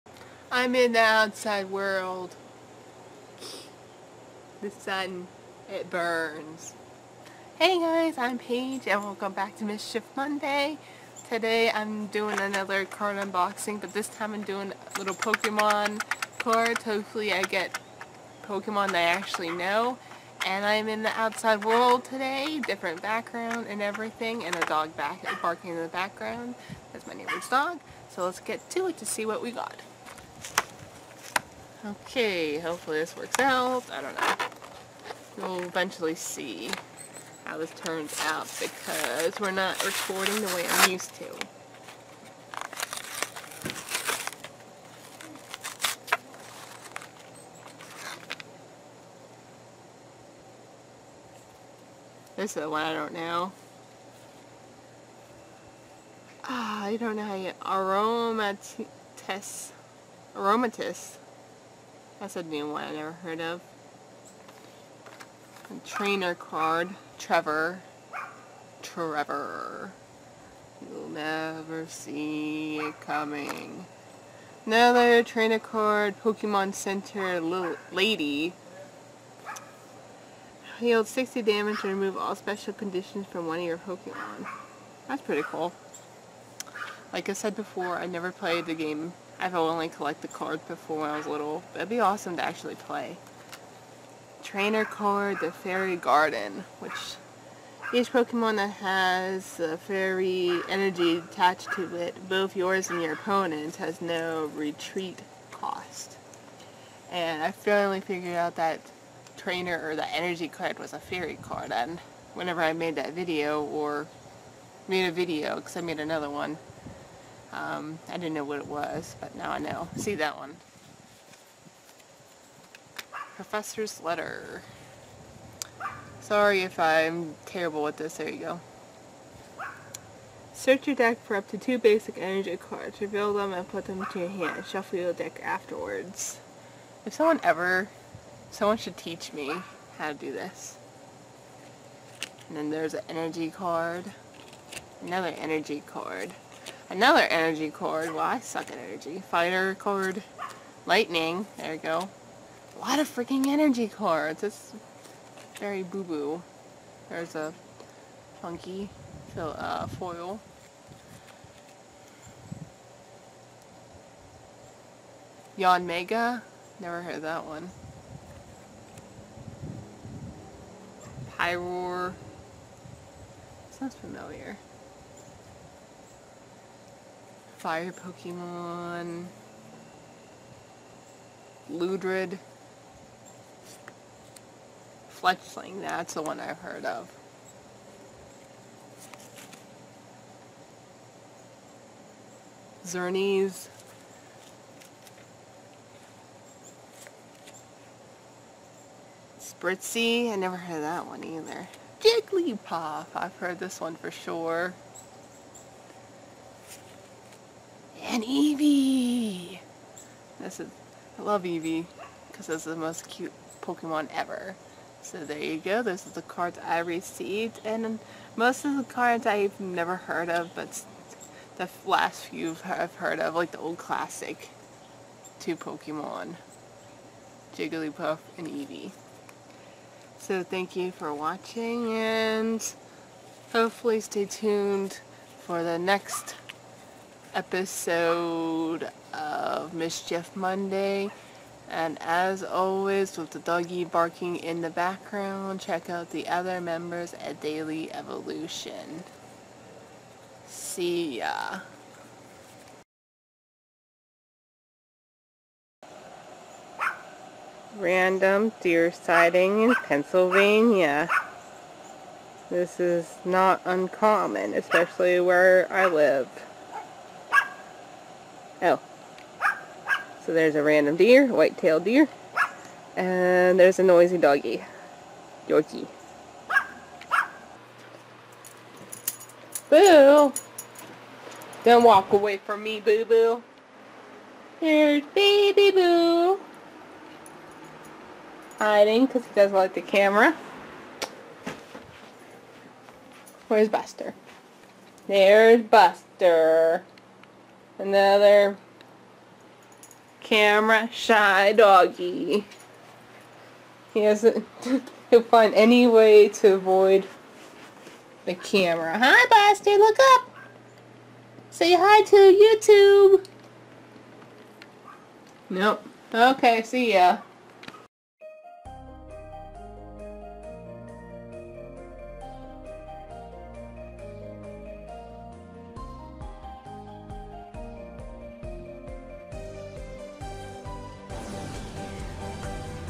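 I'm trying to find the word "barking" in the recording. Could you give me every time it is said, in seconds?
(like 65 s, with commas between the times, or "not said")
25 s, 243 s.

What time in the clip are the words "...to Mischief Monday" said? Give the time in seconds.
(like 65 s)
9 s.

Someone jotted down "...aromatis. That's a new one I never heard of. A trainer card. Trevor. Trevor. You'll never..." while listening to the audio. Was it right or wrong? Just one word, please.
right.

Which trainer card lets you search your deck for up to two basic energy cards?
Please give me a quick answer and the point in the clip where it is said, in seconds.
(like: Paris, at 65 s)
Professor's Letter, at 123 s.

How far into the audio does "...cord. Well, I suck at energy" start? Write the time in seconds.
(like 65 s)
147 s.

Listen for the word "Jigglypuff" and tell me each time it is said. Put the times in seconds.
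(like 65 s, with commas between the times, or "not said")
201 s, 227 s.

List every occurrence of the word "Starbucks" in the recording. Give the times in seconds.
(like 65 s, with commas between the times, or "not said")
not said.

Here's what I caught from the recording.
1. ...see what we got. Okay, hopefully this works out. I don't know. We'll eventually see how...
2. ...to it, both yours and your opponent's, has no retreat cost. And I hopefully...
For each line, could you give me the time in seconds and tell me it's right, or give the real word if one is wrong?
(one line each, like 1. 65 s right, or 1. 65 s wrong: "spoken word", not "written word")
1. 29 s right
2. 101 s wrong: "finally", not "hopefully".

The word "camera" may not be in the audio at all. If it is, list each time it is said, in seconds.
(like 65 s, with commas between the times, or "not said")
289 s, 300 s, 308 s.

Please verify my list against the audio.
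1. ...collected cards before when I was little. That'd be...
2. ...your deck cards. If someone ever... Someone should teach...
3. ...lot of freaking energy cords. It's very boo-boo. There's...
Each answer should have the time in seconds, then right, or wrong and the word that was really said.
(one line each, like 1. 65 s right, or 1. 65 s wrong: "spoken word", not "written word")
1. 89 s right
2. 134 s wrong: "afterwards", not "cards"
3. 152 s right.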